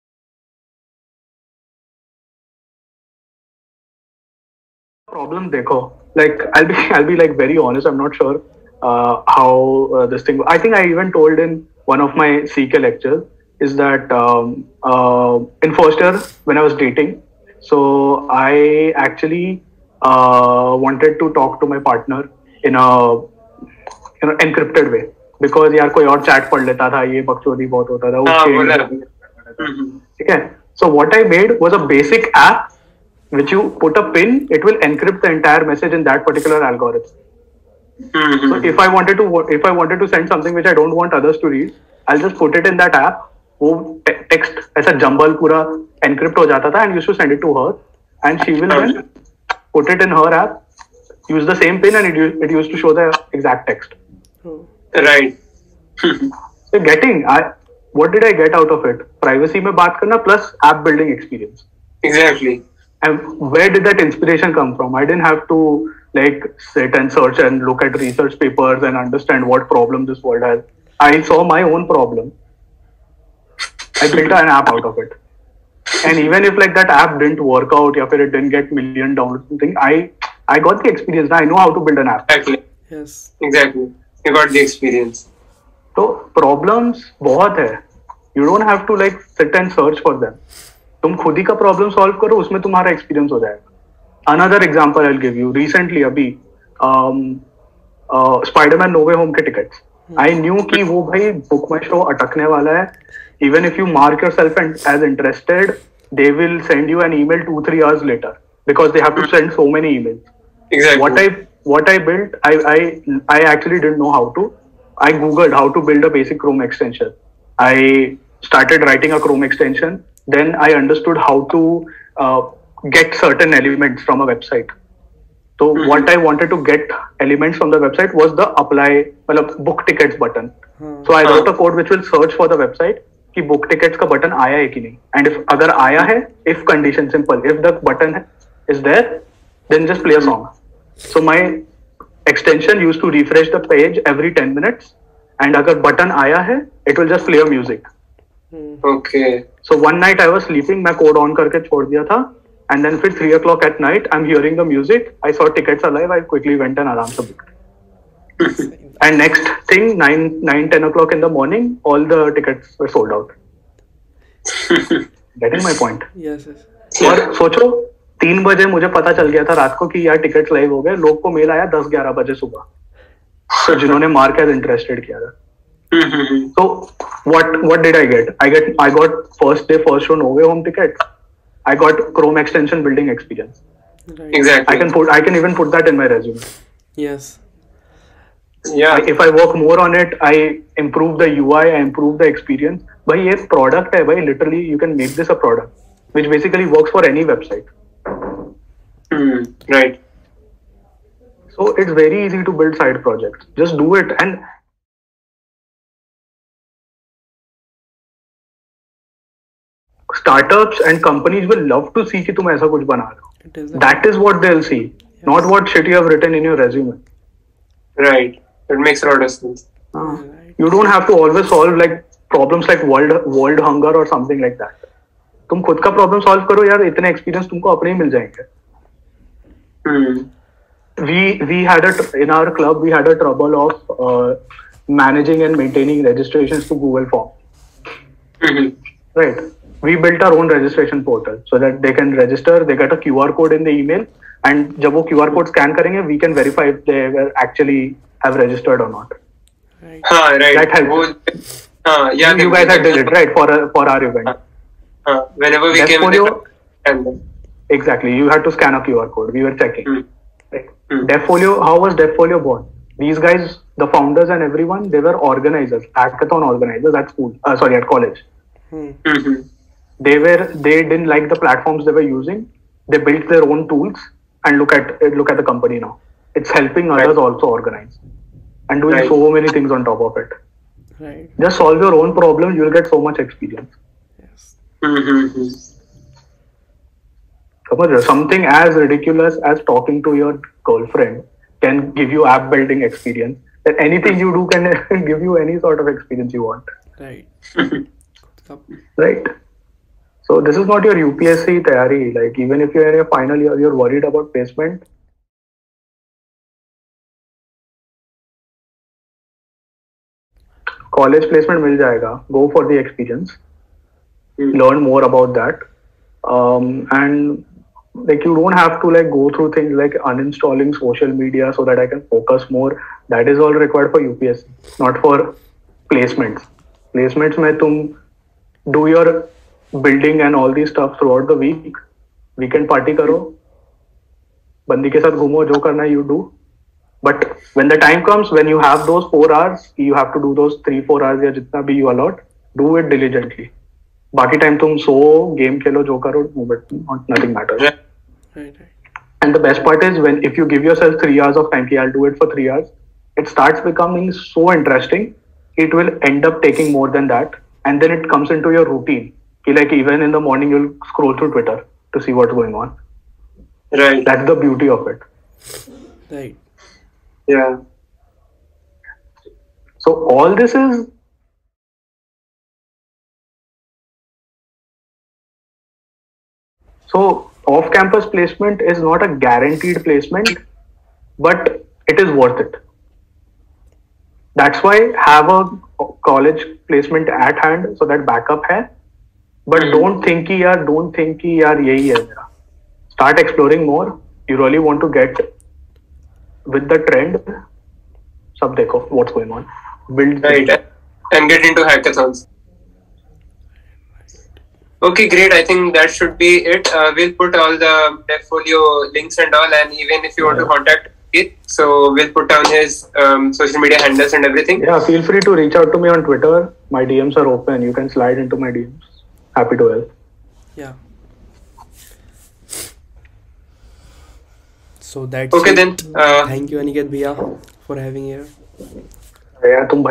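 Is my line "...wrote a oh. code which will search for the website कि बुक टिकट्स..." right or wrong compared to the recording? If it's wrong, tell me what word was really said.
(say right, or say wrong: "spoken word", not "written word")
right.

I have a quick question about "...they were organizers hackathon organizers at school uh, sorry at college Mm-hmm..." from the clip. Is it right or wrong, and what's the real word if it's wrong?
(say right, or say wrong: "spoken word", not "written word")
right.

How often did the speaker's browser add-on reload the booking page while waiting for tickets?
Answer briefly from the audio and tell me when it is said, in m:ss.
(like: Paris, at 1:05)
every 10 minutes, at 2:24.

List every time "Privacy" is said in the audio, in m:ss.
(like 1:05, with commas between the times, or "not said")
0:59.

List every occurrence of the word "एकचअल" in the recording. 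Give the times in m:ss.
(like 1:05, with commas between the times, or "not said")
0:19, 1:53.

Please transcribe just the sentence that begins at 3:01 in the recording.
I got Chrome extension building experience.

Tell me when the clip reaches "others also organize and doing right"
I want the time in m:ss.
4:37.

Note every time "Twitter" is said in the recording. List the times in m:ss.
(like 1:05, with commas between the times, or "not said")
6:01, 6:56.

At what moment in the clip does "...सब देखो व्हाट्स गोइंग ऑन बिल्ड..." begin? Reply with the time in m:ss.
6:38.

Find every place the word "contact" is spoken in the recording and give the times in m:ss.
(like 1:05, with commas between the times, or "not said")
6:50.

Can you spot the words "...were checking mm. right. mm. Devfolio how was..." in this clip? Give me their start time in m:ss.
4:19.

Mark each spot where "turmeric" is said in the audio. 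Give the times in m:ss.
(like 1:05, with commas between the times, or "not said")
not said.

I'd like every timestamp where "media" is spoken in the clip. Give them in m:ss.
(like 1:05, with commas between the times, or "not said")
5:21, 6:53.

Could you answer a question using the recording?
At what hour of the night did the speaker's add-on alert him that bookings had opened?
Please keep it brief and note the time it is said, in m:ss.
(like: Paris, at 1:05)
3 o'clock, at 2:33.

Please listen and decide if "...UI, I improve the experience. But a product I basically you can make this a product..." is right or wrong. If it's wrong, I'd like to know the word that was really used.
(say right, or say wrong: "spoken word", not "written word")
wrong: "literally", not "basically".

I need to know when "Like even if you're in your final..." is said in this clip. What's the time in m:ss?
5:02.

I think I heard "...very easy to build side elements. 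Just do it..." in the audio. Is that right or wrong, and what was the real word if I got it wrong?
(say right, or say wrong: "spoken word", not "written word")
wrong: "projects", not "elements".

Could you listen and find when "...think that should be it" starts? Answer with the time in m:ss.
6:45.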